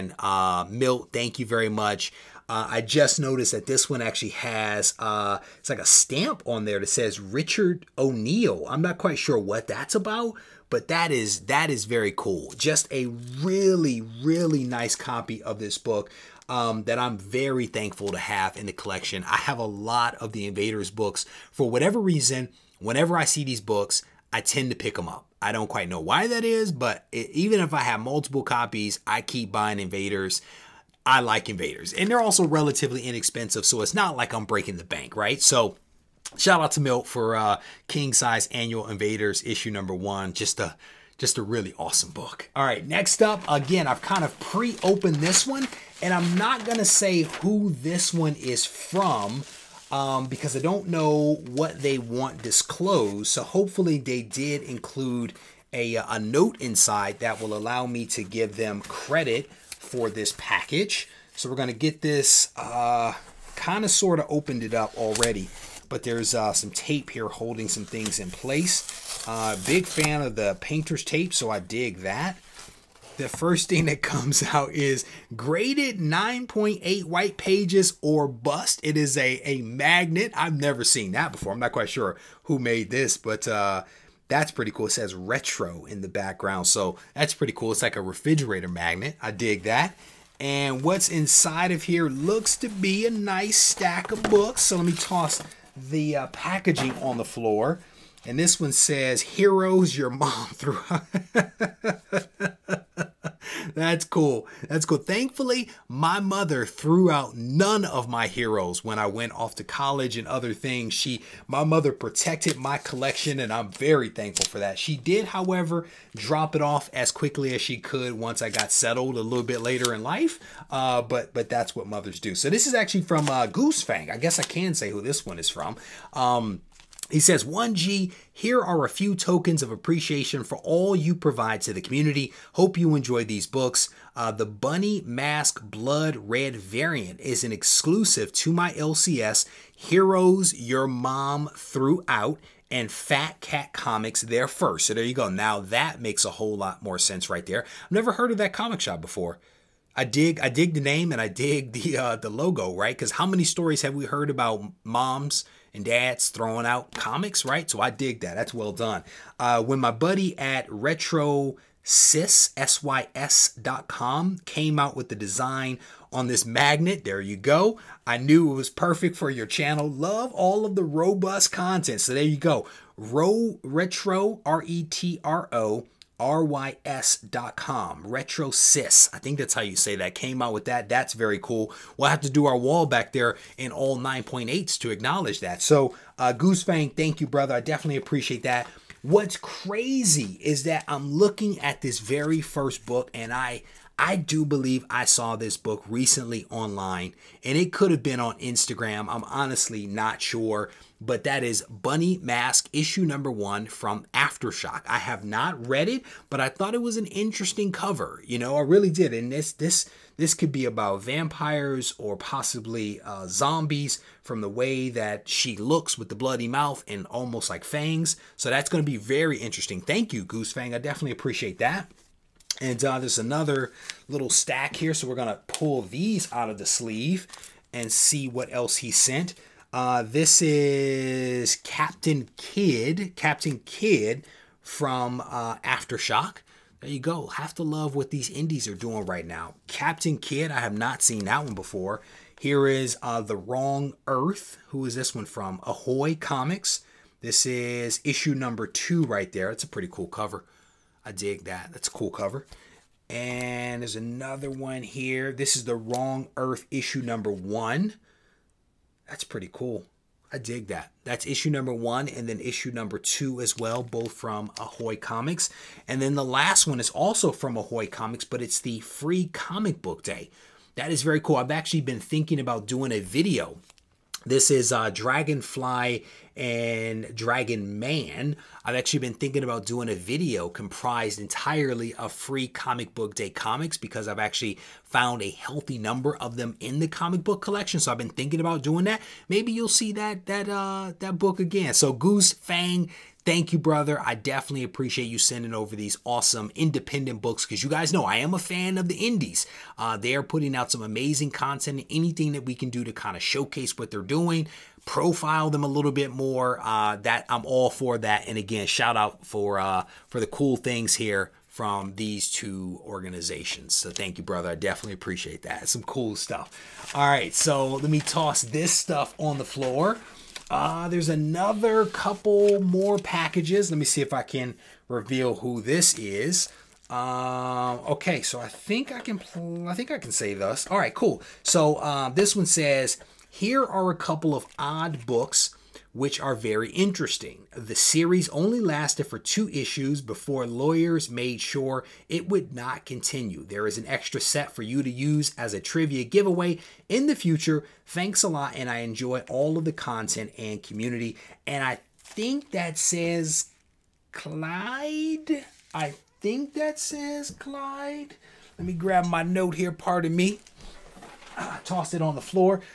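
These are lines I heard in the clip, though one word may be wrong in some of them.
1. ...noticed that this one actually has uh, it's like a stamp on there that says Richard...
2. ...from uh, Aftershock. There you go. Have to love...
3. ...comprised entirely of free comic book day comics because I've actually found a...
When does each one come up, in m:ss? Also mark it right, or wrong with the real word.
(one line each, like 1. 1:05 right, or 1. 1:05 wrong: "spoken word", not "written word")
1. 0:03 right
2. 3:54 right
3. 4:40 right.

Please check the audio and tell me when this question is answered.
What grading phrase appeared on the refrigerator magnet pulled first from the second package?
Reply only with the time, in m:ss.
1:15.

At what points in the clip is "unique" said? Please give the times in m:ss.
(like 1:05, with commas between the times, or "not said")
not said.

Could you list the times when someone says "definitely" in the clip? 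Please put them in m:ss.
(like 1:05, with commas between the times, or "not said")
3:07, 3:40, 4:54, 5:14.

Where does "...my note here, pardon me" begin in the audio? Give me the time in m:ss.
5:59.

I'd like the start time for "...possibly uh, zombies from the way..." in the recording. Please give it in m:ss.
3:32.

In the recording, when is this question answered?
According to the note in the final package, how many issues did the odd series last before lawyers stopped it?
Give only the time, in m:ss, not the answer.
5:39.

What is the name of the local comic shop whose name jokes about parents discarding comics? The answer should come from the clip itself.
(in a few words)
Heroes Your Mom Threw Out.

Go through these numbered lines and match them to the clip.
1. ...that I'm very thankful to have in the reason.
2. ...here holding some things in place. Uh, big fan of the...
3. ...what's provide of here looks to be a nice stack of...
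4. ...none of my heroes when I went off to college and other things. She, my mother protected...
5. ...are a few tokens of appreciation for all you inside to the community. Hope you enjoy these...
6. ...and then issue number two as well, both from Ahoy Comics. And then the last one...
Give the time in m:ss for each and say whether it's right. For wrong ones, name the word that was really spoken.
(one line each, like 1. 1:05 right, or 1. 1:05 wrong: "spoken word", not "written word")
1. 0:16 wrong: "collection", not "reason"
2. 1:07 right
3. 1:30 wrong: "inside", not "provide"
4. 1:47 right
5. 2:08 wrong: "provide", not "inside"
6. 4:22 right.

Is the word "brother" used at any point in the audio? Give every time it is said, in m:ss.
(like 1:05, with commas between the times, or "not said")
3:07, 4:53, 5:14.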